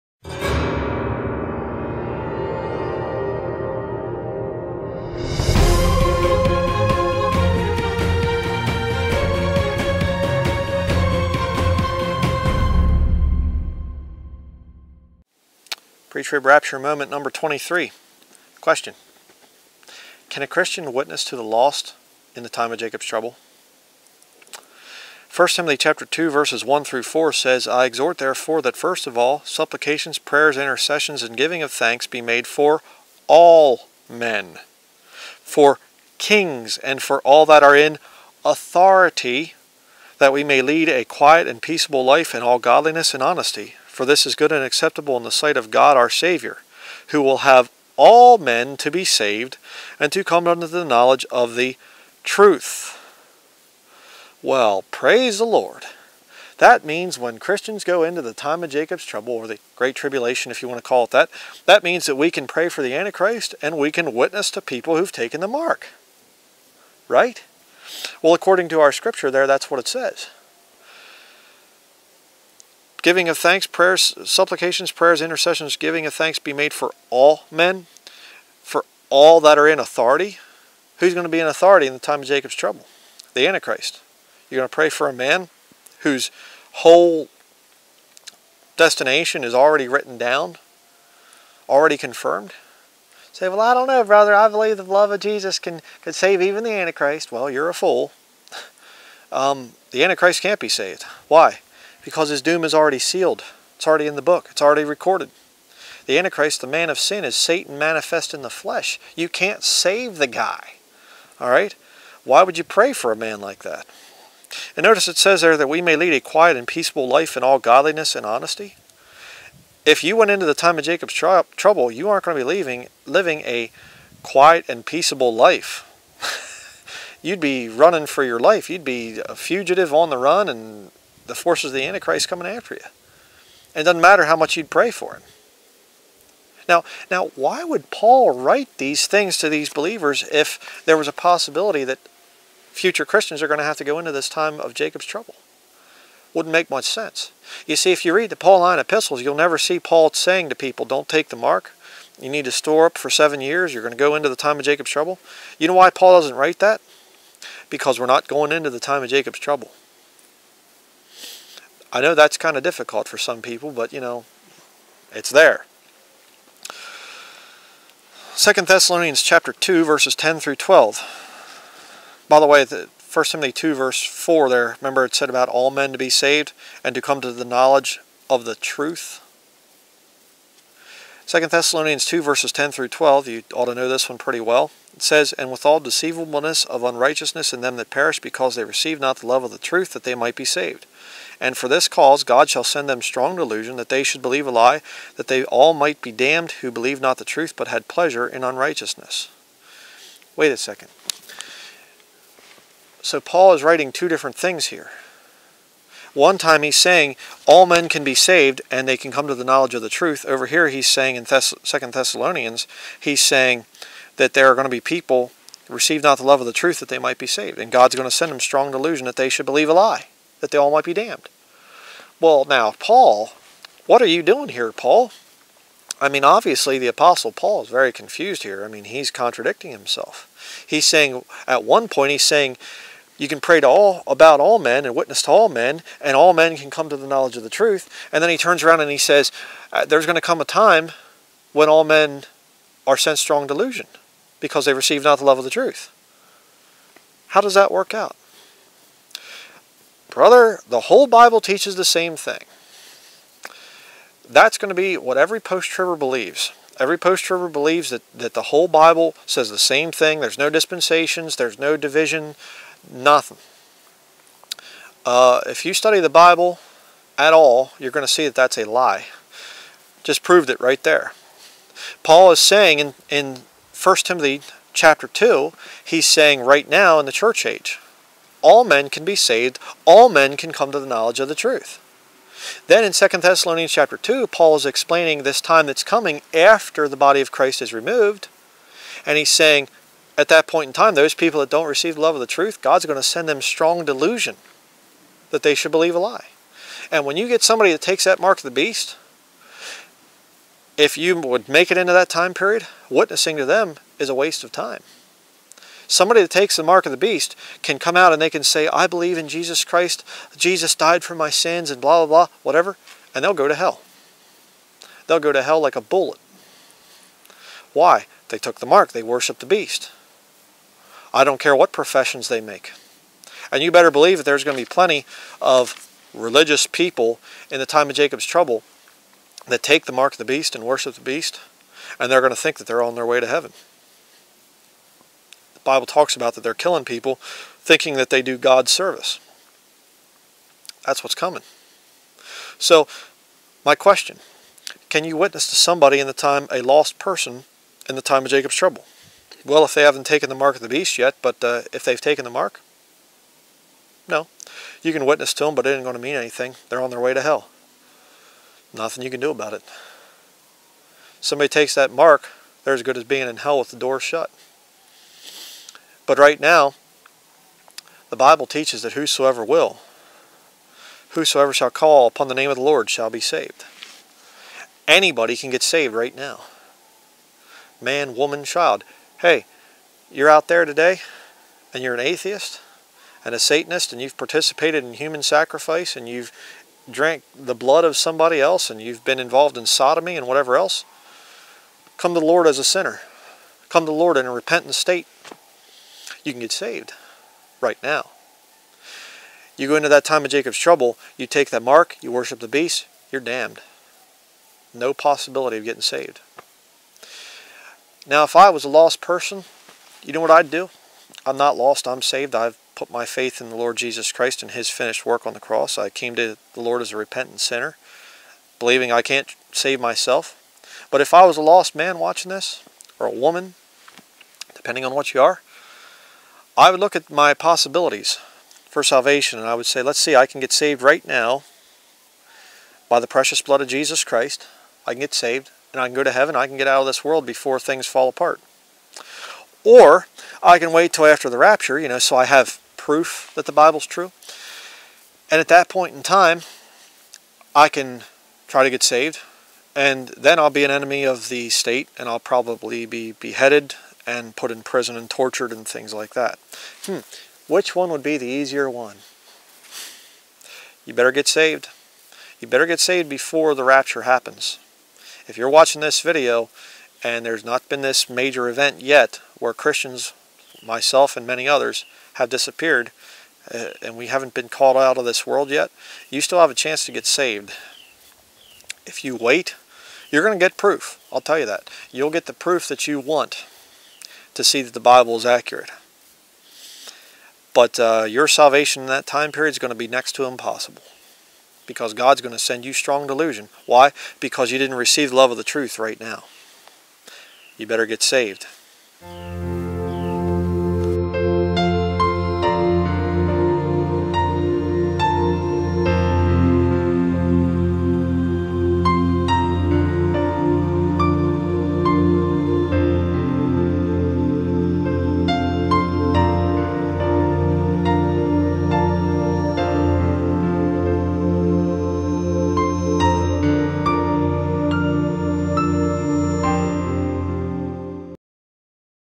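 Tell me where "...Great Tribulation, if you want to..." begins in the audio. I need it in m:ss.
0:59.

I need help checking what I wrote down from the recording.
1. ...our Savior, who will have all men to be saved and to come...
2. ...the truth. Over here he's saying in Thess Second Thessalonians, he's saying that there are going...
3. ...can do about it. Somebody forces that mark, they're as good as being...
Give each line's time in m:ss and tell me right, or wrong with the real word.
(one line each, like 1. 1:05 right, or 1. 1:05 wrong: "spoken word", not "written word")
1. 0:45 right
2. 3:29 right
3. 5:59 wrong: "takes", not "forces".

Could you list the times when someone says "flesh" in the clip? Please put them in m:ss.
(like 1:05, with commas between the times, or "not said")
1:48.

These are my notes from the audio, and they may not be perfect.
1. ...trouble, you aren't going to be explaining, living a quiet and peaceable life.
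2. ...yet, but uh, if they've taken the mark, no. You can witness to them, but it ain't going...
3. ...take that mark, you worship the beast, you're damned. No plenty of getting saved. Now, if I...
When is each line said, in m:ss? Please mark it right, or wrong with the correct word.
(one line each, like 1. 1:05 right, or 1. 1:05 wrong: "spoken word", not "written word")
1. 2:01 wrong: "leaving", not "explaining"
2. 5:50 right
3. 6:41 wrong: "possibility", not "plenty".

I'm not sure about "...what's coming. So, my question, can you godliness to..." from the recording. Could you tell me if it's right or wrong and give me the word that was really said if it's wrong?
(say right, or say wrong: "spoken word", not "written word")
wrong: "witness", not "godliness".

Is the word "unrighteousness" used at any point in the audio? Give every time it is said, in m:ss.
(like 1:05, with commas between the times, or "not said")
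3:06, 3:18.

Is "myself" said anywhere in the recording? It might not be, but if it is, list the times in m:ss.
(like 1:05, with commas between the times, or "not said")
6:59, 7:50.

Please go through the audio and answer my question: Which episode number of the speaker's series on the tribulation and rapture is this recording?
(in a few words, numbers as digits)
23.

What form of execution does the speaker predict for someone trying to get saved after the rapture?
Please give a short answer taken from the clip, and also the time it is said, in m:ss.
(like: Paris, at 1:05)
Beheaded, at 7:33.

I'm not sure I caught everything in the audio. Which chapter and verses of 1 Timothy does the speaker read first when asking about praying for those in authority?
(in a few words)
Chapter 2, verses 1-4.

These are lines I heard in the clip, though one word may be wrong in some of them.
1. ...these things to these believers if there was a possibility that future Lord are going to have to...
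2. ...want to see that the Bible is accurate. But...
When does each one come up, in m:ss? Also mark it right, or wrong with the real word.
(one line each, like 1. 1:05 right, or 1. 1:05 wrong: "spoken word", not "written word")
1. 2:18 wrong: "Christians", not "Lord"
2. 8:02 right.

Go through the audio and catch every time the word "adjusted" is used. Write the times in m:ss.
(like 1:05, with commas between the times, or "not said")
not said.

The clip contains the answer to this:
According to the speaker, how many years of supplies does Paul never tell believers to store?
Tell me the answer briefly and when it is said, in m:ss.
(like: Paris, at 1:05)
7, at 2:33.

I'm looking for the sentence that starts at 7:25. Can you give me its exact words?
And at that point in time, I can try to get saved.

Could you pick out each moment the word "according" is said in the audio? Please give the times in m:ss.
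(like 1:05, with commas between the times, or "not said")
1:08.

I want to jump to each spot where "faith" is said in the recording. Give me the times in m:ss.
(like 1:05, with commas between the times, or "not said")
6:53.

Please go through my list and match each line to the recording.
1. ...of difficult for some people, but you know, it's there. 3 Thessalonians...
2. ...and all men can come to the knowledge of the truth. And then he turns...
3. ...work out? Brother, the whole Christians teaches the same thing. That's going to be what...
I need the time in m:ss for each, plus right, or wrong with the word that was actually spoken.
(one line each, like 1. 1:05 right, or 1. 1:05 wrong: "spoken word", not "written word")
1. 2:42 wrong: "2", not "3"
2. 3:56 right
3. 4:07 wrong: "Bible", not "Christians".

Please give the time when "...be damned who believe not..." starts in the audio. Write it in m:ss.
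3:15.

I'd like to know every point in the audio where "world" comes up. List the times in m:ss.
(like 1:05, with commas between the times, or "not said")
7:17, 7:55.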